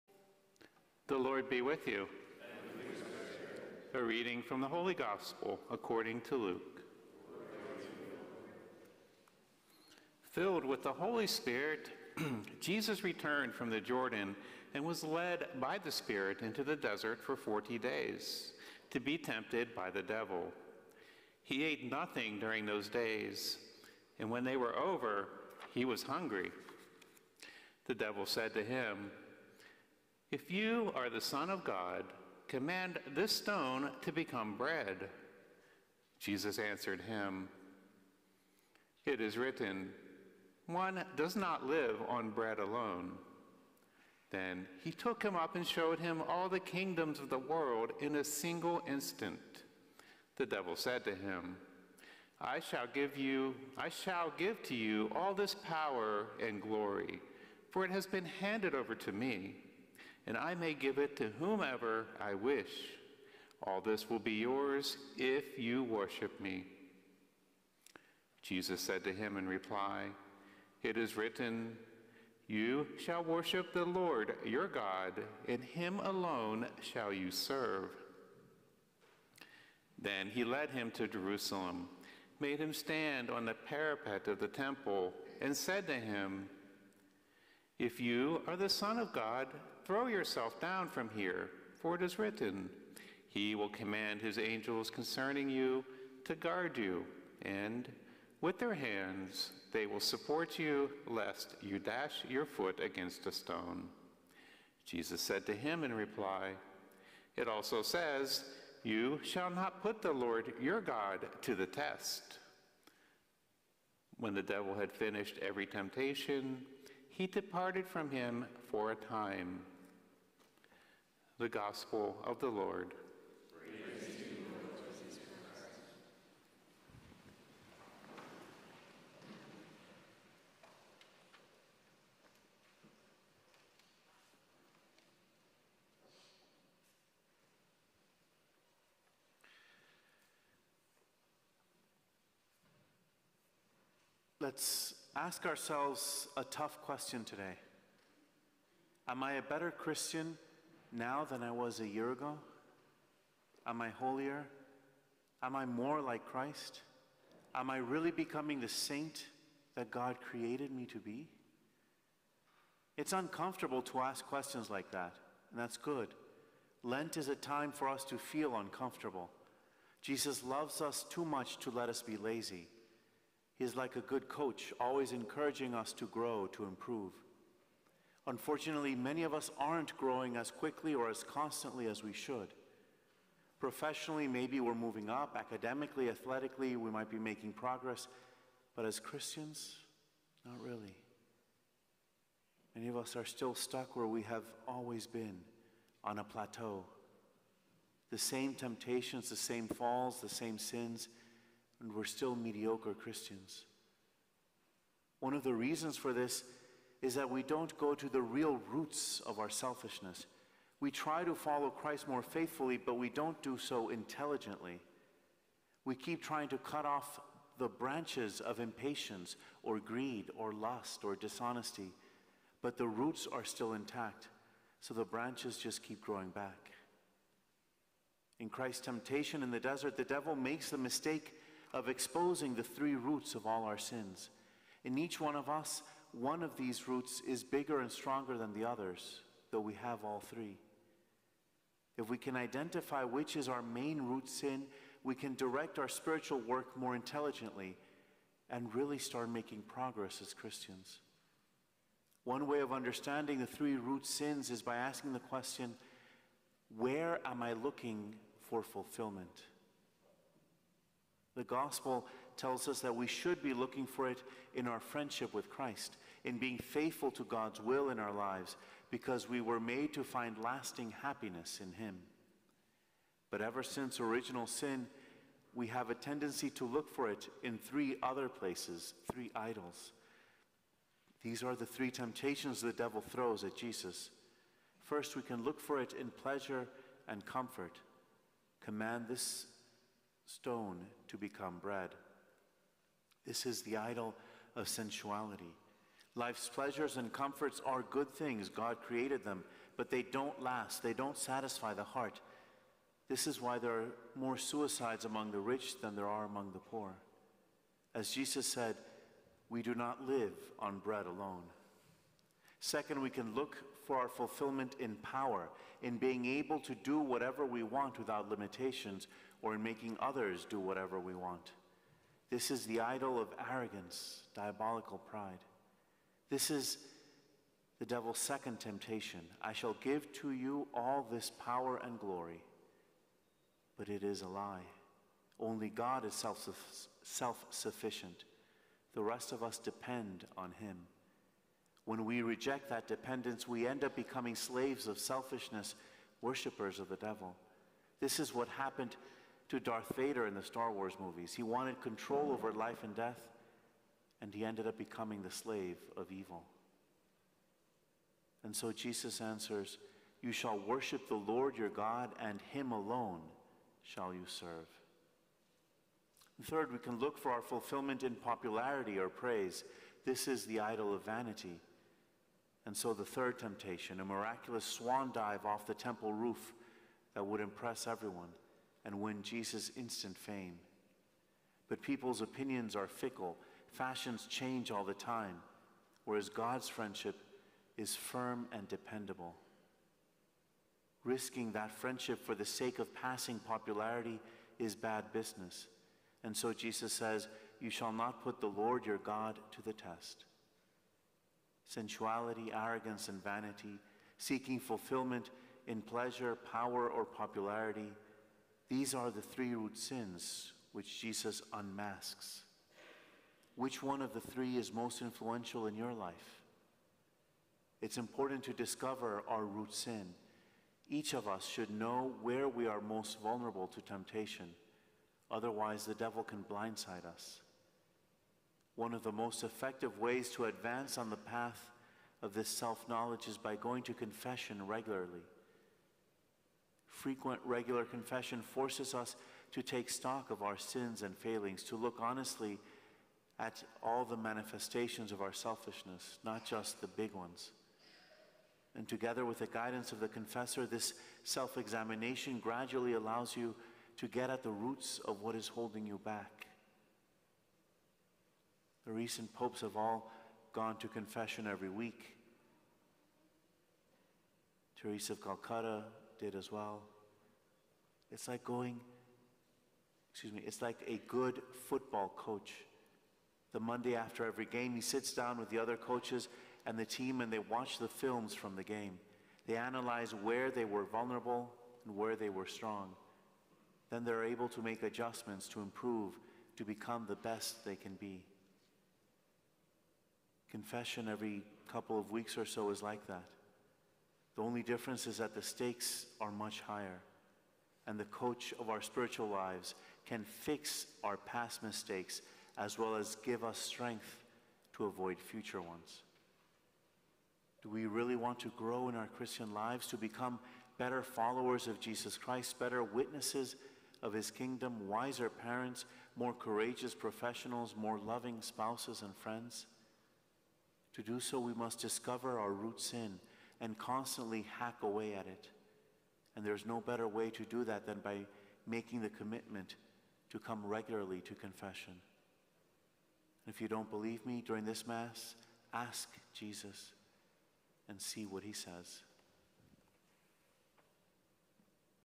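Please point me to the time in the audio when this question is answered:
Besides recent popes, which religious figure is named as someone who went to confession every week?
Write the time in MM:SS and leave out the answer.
07:44.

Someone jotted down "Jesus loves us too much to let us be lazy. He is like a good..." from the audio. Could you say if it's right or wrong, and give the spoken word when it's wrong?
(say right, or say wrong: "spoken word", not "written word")
right.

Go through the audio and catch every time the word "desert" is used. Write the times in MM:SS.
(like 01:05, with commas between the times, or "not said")
00:16, 03:49.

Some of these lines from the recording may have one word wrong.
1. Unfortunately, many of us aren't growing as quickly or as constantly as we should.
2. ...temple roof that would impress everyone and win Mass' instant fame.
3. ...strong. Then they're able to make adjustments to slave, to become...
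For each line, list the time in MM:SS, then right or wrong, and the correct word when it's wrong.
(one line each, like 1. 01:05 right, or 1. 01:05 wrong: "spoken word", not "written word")
1. 02:58 right
2. 06:15 wrong: "Jesus", not "Mass"
3. 08:02 wrong: "improve", not "slave".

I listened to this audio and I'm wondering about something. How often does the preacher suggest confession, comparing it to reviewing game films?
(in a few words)
Every couple of weeks.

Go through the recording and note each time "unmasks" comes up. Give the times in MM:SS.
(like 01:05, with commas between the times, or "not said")
06:51.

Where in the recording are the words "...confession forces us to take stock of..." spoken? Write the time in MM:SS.
07:17.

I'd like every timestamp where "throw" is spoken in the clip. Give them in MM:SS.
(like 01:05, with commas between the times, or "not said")
01:29, 04:43.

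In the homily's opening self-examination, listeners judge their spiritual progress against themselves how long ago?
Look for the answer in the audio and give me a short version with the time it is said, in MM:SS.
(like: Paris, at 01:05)
A year ago, at 02:31.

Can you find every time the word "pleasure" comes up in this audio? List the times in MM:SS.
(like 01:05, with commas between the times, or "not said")
04:46, 04:56, 06:45.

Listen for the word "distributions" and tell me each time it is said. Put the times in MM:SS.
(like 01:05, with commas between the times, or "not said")
not said.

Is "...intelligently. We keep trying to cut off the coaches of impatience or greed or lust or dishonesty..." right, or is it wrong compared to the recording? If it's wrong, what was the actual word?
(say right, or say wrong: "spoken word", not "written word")
wrong: "branches", not "coaches".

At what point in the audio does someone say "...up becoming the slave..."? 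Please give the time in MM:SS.
05:54.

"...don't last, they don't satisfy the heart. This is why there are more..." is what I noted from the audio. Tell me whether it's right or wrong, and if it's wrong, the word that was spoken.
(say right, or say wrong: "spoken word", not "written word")
right.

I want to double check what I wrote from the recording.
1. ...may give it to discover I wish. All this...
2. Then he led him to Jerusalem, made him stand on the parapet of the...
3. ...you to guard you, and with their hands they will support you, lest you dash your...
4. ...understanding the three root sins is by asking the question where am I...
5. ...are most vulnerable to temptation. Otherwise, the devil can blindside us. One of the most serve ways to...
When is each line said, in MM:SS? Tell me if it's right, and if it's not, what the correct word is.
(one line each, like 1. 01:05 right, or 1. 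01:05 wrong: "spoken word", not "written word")
1. 01:00 wrong: "whomever", not "discover"
2. 01:20 right
3. 01:35 right
4. 04:12 right
5. 07:02 wrong: "effective", not "serve".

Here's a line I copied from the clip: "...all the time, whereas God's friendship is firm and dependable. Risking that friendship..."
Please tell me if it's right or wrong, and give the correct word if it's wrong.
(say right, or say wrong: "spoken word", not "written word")
right.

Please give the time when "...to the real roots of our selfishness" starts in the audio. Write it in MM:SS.
03:27.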